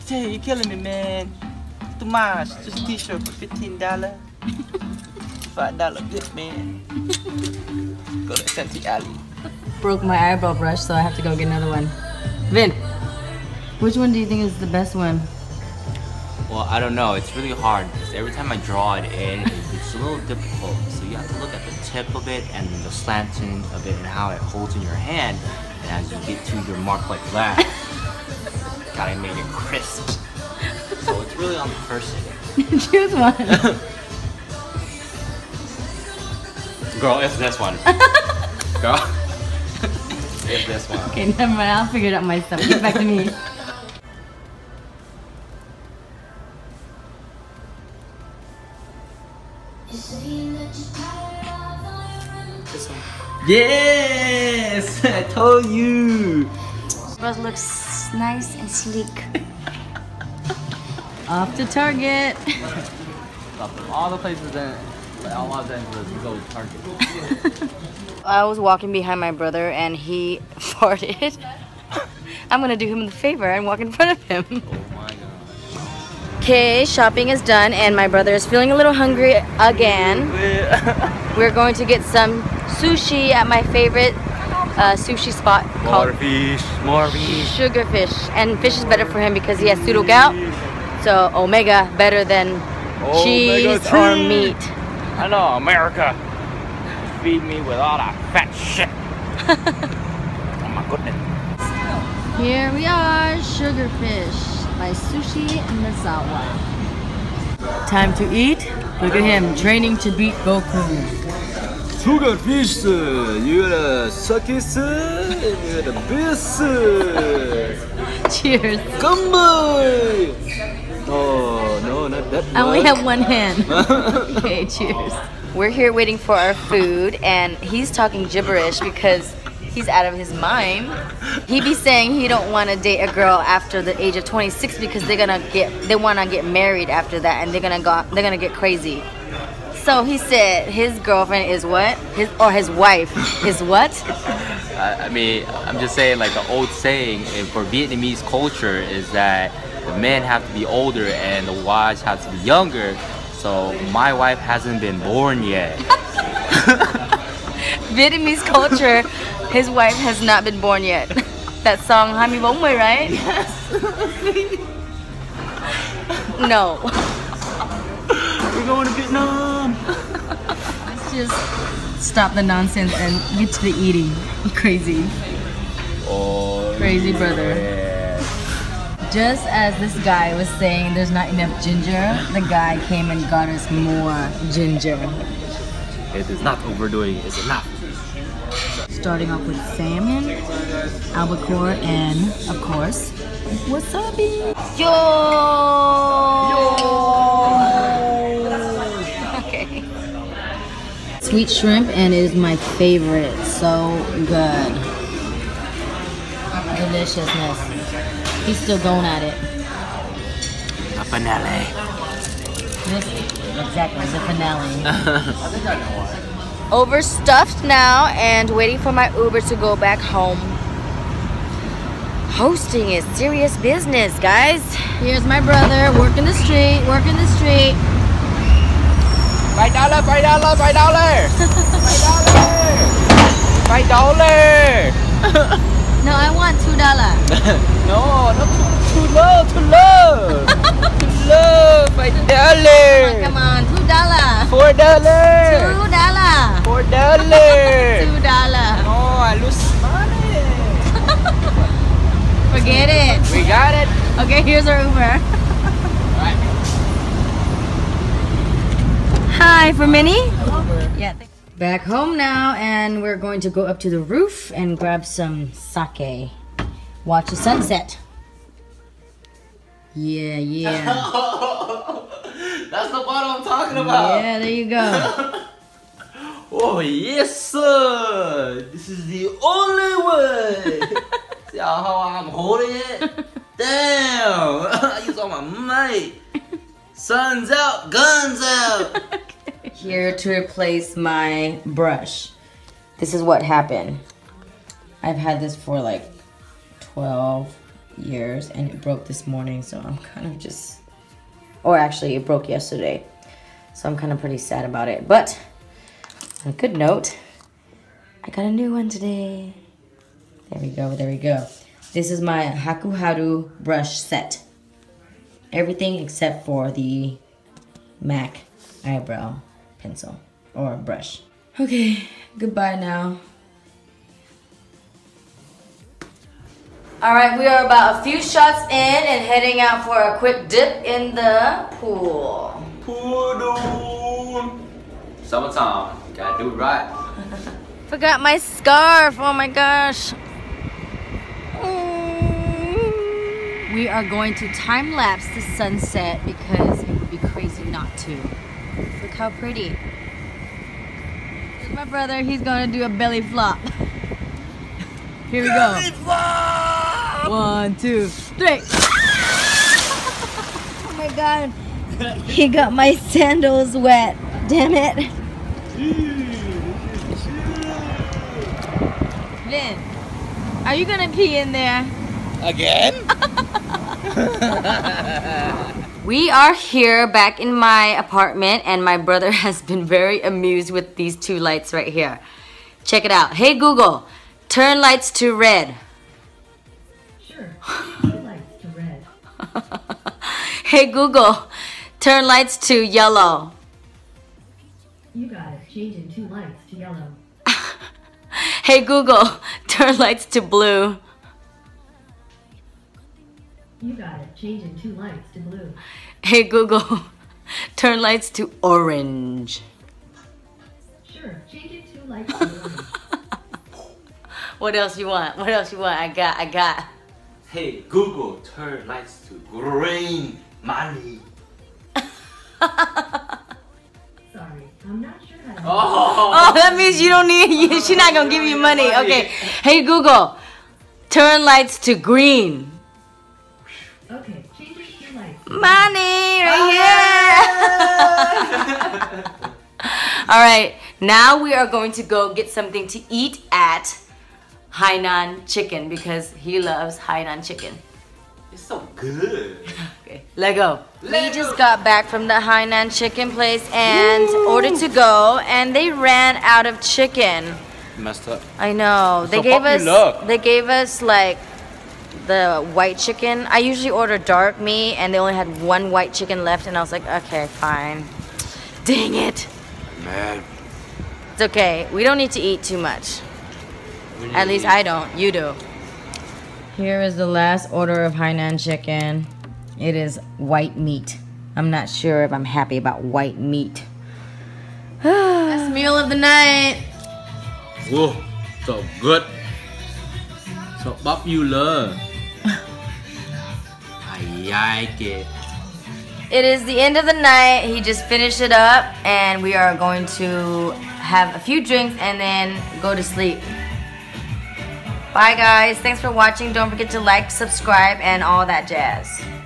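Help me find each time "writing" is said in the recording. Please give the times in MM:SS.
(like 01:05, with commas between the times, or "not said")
not said.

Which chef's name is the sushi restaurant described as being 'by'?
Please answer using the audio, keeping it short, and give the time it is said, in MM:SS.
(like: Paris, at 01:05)
Sushi Nozawa, at 01:44.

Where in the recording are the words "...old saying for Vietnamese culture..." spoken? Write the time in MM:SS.
02:26.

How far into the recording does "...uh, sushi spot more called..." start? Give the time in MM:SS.
01:24.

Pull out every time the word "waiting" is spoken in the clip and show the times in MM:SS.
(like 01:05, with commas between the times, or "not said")
02:05, 03:38.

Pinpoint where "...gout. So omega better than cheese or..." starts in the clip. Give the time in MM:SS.
01:30.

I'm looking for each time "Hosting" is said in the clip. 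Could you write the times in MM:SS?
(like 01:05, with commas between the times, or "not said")
03:42.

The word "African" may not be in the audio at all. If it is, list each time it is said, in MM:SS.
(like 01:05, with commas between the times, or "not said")
not said.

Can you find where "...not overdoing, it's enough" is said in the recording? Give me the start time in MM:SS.
03:06.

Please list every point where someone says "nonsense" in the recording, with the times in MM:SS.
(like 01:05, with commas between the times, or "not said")
02:52.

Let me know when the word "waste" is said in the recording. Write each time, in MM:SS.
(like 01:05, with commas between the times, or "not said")
not said.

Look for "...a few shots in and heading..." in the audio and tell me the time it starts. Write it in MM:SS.
05:27.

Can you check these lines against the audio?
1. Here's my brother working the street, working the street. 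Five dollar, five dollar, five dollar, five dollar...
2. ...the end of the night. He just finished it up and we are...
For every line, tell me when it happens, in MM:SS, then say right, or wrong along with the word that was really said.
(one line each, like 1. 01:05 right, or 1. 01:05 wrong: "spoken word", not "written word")
1. 03:45 right
2. 08:16 right.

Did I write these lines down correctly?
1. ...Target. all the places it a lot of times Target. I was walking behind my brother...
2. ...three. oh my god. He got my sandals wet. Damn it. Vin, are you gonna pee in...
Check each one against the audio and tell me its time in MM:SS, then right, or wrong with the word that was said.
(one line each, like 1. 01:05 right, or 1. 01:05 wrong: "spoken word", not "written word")
1. 01:01 right
2. 05:58 right.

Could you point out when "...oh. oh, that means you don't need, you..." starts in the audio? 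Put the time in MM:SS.
07:05.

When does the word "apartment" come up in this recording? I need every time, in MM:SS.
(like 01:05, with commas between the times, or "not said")
06:17.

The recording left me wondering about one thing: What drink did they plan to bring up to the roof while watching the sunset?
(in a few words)
Sake.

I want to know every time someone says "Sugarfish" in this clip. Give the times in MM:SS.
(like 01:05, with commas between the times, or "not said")
01:27, 01:43, 01:52.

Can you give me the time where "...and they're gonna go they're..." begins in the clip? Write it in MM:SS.
02:17.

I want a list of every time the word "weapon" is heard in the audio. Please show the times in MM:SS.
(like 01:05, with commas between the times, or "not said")
not said.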